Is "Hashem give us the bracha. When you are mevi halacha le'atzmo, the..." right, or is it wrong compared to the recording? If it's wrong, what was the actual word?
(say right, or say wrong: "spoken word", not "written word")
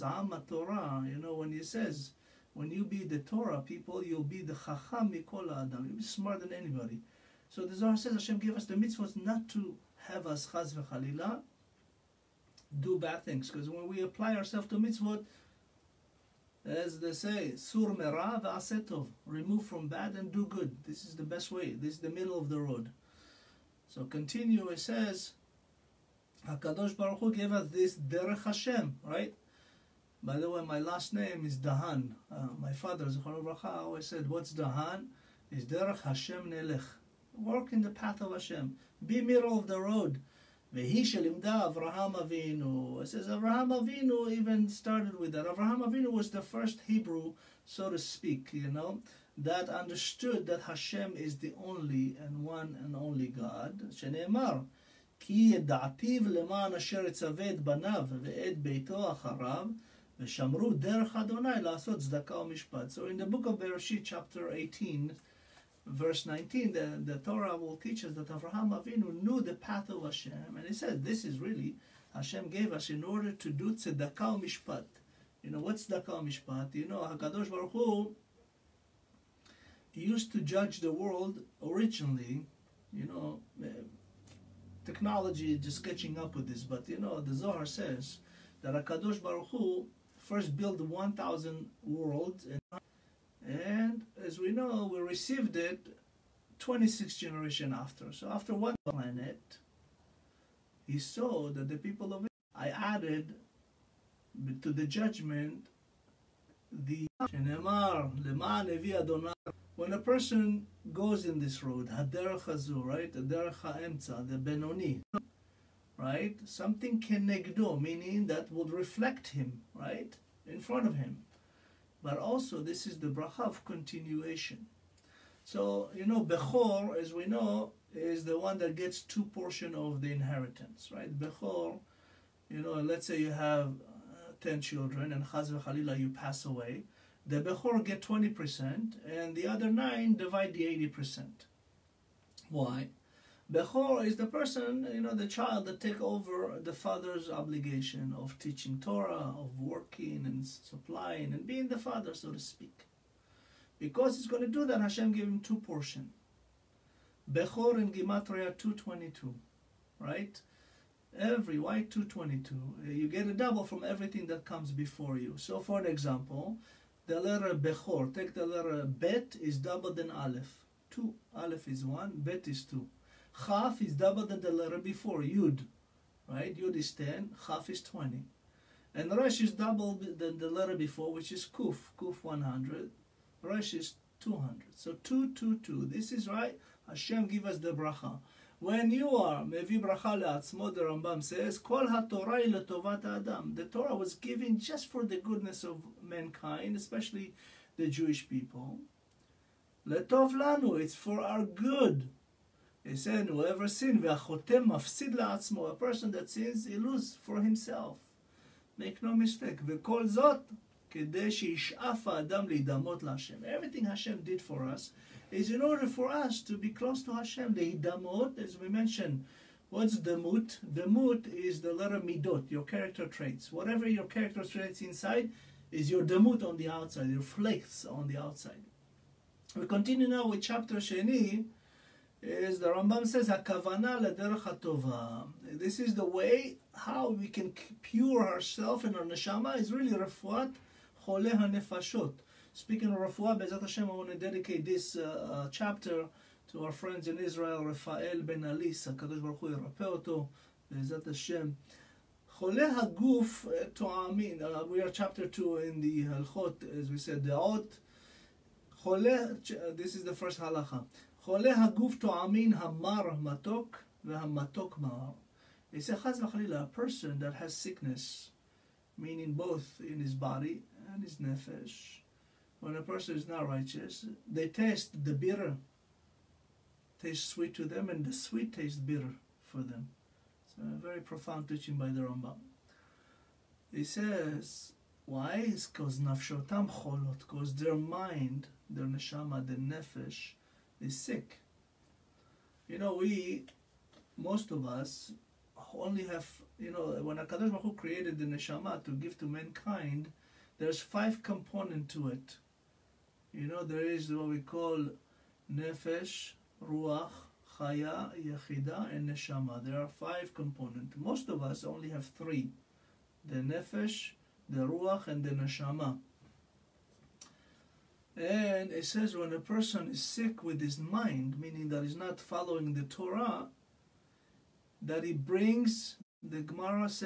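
wrong: "bracha", not "halacha".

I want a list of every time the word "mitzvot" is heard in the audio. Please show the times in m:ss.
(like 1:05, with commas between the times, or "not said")
0:08, 0:14.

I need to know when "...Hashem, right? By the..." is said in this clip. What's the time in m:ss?
0:28.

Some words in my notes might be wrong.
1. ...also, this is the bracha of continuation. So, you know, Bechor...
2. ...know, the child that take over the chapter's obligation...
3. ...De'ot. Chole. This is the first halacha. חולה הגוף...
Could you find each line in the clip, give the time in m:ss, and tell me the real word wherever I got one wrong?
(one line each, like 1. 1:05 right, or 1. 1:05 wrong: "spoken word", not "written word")
1. 2:02 right
2. 2:25 wrong: "father", not "chapter"
3. 4:17 right.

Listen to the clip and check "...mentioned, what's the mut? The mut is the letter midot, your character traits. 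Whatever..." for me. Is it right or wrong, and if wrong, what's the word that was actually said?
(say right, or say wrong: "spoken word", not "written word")
right.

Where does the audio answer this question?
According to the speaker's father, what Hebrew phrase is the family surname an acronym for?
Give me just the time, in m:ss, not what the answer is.
0:35.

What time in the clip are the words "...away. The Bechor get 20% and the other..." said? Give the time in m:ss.
2:16.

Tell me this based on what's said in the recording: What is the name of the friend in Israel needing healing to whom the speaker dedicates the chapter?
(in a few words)
Rafael ben Alis.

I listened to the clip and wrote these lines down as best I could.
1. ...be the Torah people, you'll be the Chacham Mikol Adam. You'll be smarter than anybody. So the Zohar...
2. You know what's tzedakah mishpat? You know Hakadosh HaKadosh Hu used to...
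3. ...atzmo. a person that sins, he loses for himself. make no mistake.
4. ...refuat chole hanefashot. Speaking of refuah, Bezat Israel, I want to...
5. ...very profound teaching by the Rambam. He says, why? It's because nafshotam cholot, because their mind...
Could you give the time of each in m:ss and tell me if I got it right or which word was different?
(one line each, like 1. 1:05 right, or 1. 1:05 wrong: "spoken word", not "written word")
1. 0:02 right
2. 1:15 wrong: "Baruch", not "HaKadosh"
3. 3:25 right
4. 3:59 wrong: "Hashem", not "Israel"
5. 4:40 right.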